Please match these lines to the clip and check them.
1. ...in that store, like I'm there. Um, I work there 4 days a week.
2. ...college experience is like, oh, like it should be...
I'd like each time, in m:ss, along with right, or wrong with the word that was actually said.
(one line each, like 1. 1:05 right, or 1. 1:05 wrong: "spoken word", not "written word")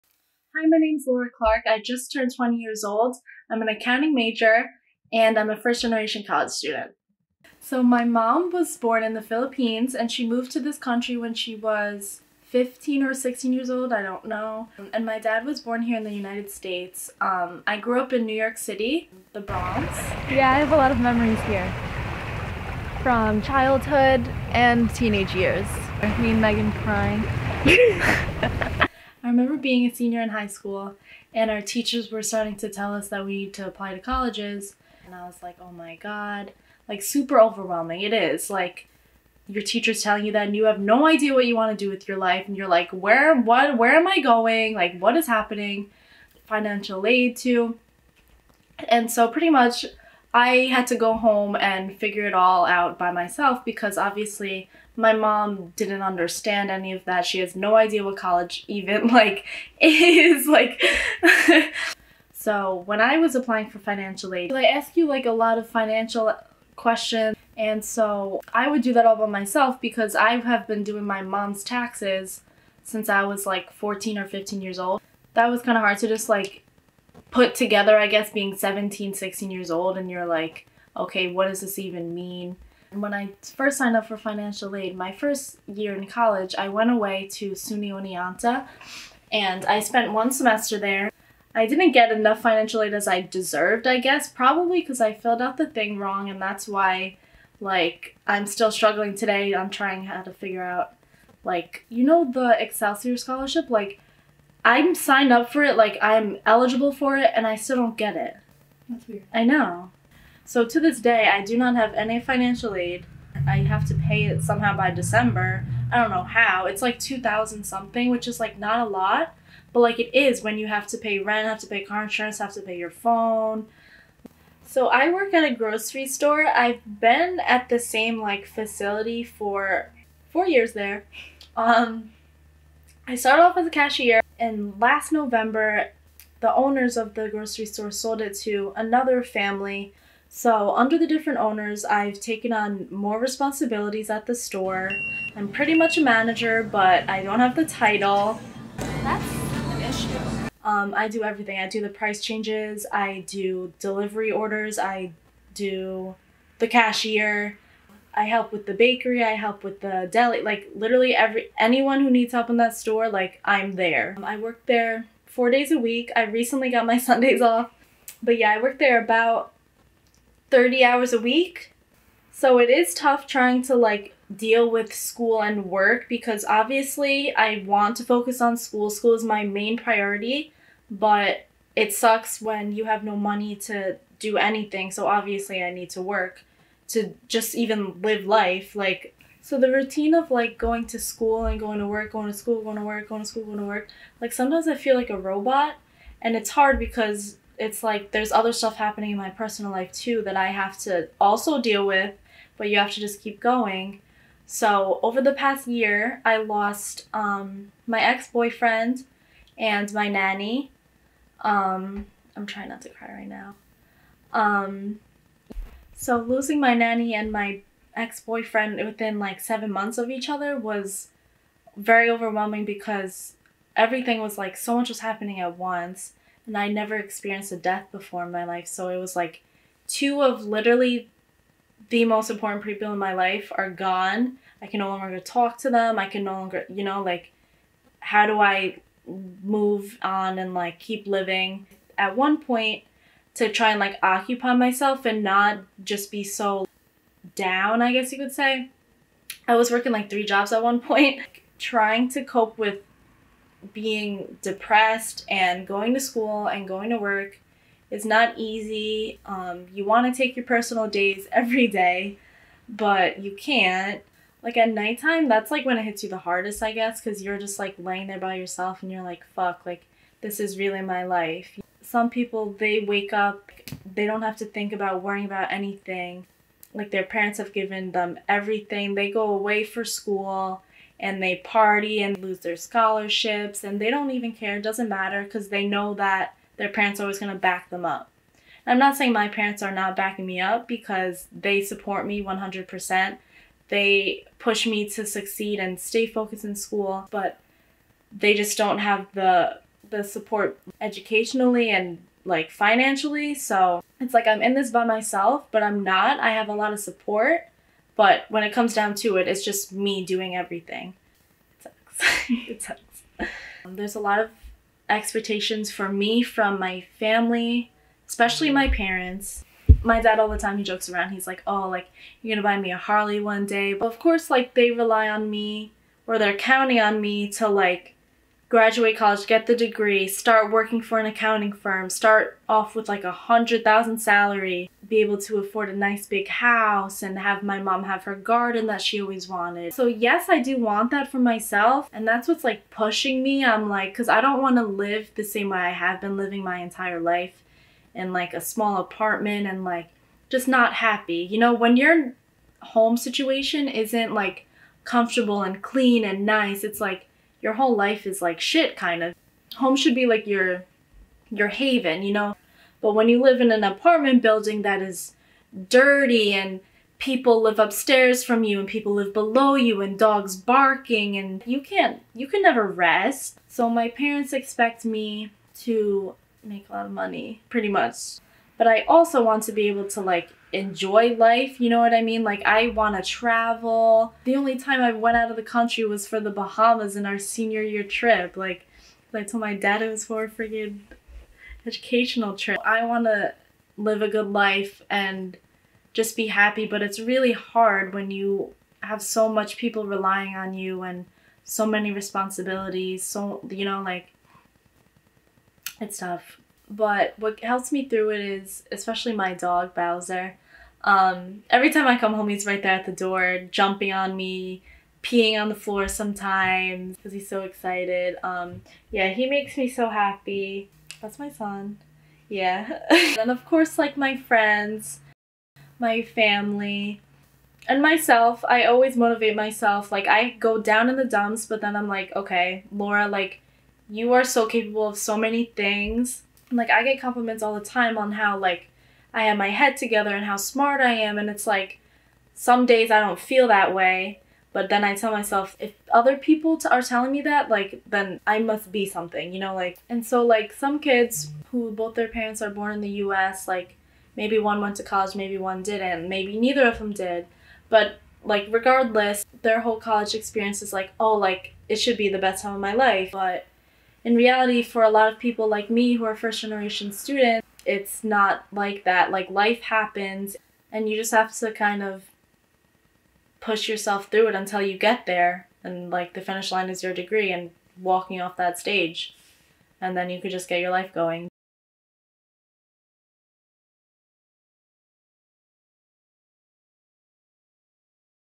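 1. 2:42 right
2. 7:39 right.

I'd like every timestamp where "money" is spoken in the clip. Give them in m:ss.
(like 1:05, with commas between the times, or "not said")
3:03, 6:16.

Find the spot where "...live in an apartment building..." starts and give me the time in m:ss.
6:03.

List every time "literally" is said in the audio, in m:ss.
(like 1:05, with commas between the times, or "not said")
2:40, 3:50.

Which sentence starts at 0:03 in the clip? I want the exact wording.
I'm an accounting major and I'm a first generation college student.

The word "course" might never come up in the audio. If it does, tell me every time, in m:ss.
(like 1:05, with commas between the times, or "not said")
5:23, 7:03.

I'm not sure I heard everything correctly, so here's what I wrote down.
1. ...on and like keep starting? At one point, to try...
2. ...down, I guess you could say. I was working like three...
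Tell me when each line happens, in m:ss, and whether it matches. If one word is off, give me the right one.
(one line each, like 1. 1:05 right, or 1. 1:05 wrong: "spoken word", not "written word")
1. 4:00 wrong: "living", not "starting"
2. 4:07 right.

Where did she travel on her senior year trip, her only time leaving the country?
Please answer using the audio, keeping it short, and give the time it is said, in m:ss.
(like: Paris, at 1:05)
The Bahamas, at 6:26.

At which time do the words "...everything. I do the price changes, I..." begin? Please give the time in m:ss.
2:31.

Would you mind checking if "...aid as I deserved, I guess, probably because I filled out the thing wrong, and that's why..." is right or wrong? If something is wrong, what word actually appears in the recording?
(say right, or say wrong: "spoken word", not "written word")
right.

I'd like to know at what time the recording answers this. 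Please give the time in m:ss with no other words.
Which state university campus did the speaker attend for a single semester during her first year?
1:27.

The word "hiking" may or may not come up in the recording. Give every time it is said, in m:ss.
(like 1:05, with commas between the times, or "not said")
not said.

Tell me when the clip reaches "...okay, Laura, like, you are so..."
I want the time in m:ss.
7:12.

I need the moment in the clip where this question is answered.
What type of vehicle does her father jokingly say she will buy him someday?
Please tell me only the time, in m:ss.
5:22.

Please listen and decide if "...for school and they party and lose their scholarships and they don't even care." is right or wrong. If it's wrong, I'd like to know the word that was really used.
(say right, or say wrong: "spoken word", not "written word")
right.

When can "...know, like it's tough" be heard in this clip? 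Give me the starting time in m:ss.
6:43.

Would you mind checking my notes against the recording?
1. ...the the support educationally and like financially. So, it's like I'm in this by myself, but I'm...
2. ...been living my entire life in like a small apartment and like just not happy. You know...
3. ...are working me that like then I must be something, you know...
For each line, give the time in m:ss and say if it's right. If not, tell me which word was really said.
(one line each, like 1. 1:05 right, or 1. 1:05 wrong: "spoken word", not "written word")
1. 4:59 right
2. 5:46 right
3. 7:26 wrong: "telling", not "working".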